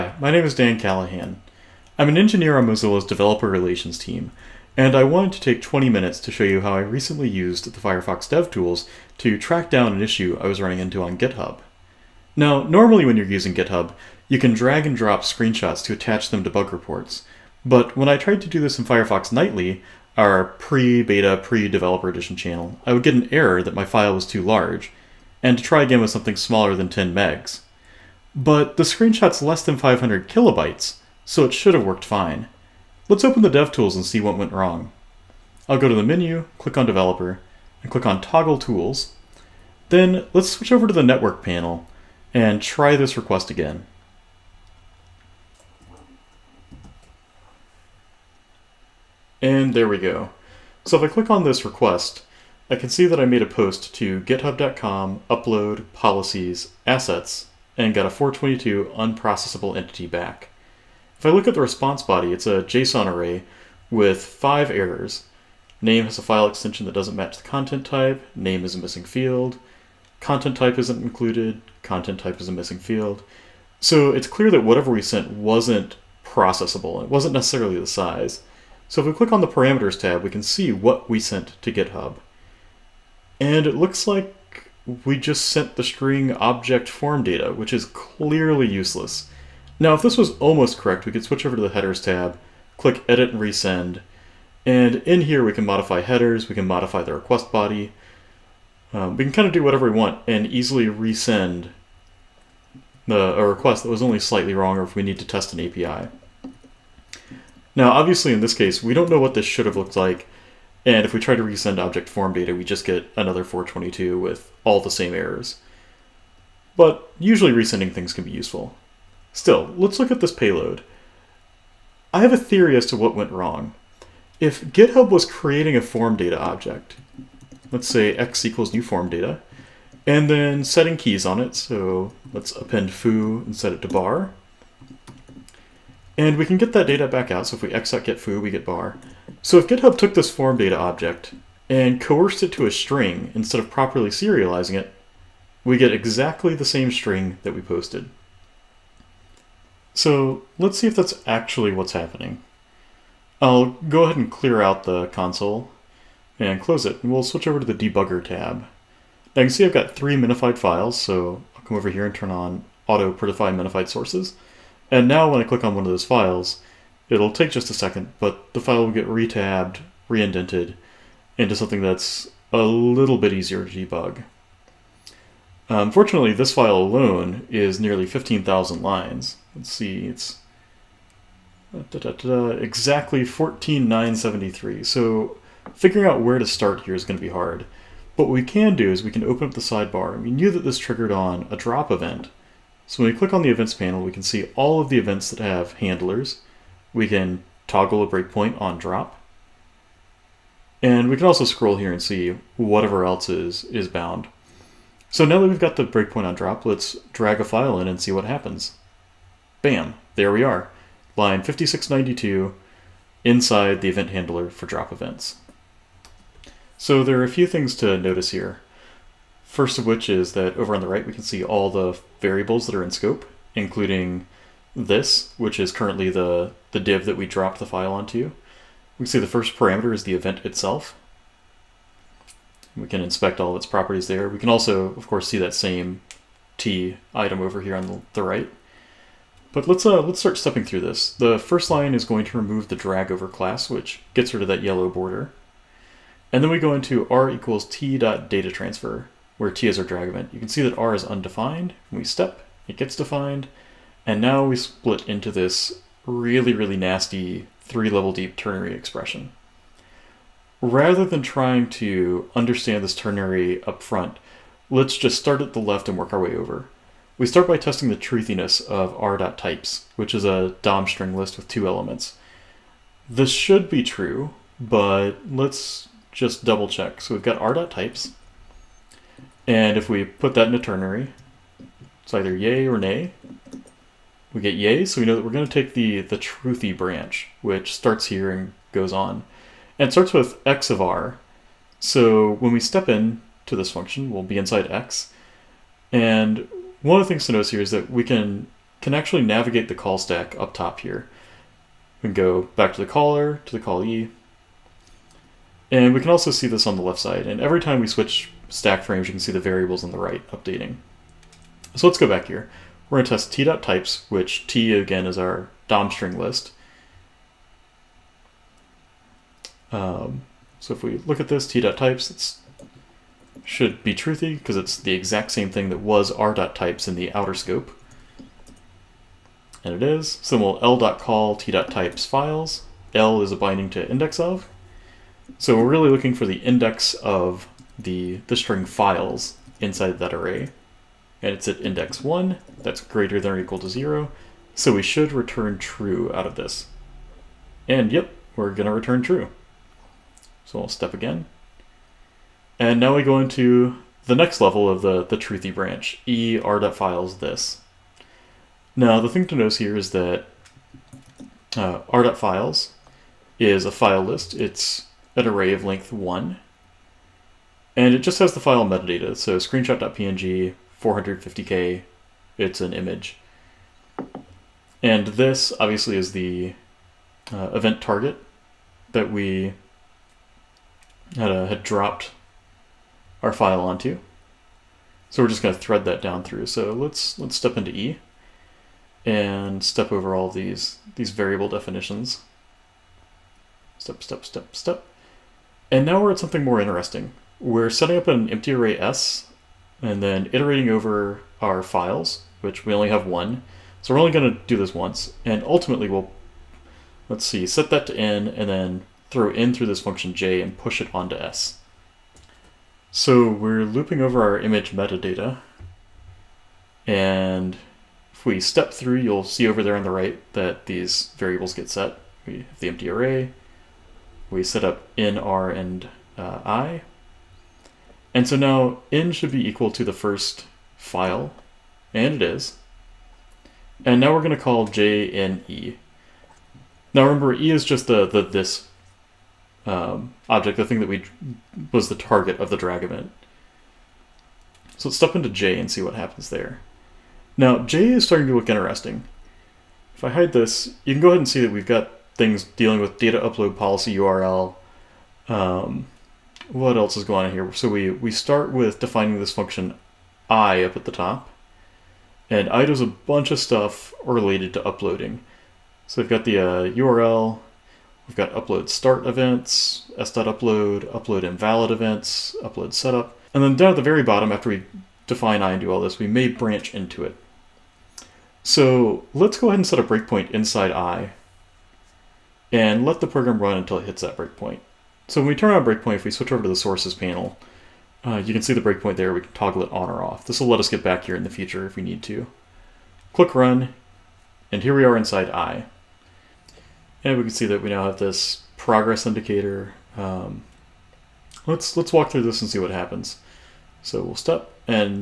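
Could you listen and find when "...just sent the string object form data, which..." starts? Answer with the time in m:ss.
1:25.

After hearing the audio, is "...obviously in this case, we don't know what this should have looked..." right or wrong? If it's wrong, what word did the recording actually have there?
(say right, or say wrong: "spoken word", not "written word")
right.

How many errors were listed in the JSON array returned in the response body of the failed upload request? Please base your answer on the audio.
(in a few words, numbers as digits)
5.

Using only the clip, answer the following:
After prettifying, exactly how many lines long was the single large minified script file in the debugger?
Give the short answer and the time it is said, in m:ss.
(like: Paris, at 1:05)
14,973, at 3:03.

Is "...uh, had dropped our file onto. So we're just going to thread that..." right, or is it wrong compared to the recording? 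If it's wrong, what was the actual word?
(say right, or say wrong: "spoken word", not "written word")
right.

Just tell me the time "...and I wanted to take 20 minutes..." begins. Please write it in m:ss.
0:04.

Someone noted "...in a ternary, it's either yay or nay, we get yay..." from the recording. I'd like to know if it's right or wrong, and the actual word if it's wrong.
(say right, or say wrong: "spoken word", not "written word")
right.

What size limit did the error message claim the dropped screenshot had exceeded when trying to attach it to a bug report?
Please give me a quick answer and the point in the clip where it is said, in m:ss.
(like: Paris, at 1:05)
10 megs, at 0:26.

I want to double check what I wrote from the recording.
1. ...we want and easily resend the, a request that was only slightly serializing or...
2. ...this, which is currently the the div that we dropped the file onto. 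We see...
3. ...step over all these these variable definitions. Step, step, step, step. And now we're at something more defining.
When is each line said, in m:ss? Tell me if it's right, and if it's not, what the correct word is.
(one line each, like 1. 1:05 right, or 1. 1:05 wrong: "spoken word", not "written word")
1. 1:39 wrong: "wrong", not "serializing"
2. 3:44 right
3. 6:29 wrong: "interesting", not "defining".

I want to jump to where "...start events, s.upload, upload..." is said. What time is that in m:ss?
7:48.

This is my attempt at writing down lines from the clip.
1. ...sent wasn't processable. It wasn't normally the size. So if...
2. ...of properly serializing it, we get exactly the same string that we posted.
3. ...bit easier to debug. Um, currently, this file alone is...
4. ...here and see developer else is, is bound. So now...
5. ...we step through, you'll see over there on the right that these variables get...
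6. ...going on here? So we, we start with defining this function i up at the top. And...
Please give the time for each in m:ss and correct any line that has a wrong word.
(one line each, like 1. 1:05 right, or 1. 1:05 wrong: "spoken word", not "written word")
1. 1:15 wrong: "necessarily", not "normally"
2. 2:23 right
3. 2:53 wrong: "fortunately", not "currently"
4. 3:21 wrong: "whatever", not "developer"
5. 6:58 right
6. 7:37 right.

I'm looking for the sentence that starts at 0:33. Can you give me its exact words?
Let's open the DevTools and see what went wrong.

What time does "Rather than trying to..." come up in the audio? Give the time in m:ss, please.
4:20.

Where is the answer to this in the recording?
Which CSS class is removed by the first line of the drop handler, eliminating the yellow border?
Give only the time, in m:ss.
4:02.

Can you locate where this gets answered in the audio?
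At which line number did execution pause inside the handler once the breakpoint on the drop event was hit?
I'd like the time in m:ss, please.
3:31.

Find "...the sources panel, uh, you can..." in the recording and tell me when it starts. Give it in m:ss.
8:06.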